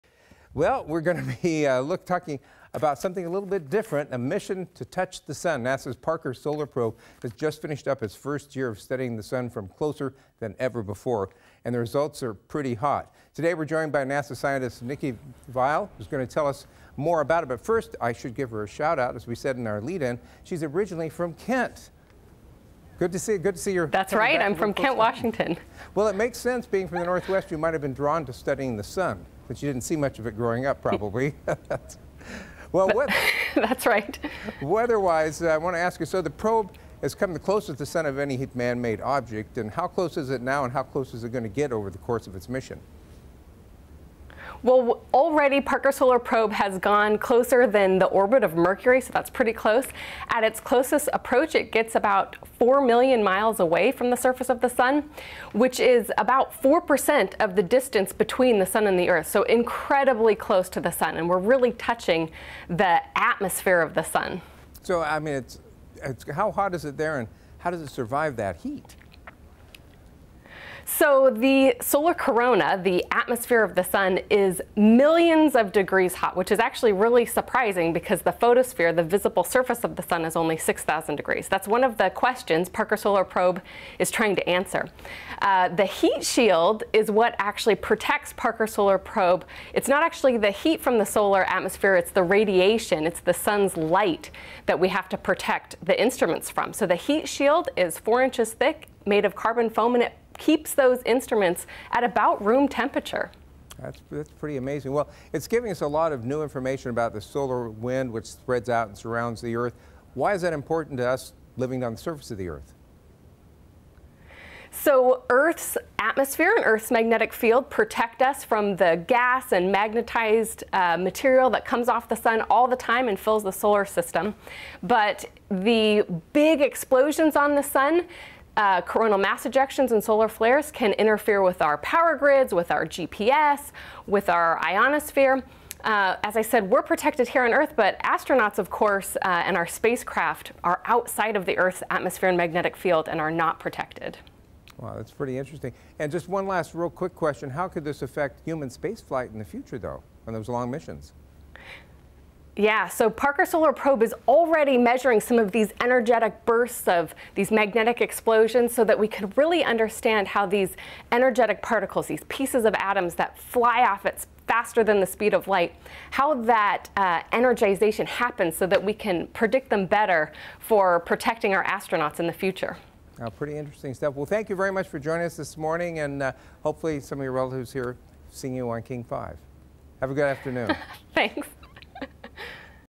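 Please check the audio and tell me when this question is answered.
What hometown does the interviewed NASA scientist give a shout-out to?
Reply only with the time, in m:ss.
0:24.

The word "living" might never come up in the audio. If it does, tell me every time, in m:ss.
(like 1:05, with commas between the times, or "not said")
1:51.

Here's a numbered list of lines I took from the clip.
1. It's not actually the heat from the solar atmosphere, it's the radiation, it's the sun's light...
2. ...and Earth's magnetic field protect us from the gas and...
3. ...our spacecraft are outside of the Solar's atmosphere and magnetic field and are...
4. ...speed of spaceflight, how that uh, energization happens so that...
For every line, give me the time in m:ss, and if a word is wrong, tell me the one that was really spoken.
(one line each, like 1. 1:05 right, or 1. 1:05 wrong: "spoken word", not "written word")
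1. 1:29 right
2. 1:56 right
3. 2:19 wrong: "Earth", not "Solar"
4. 2:45 wrong: "light", not "spaceflight".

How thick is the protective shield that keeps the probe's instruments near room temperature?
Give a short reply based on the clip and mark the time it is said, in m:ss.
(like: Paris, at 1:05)
4 inches, at 1:37.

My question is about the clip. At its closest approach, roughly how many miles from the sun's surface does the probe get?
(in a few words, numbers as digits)
4 million miles.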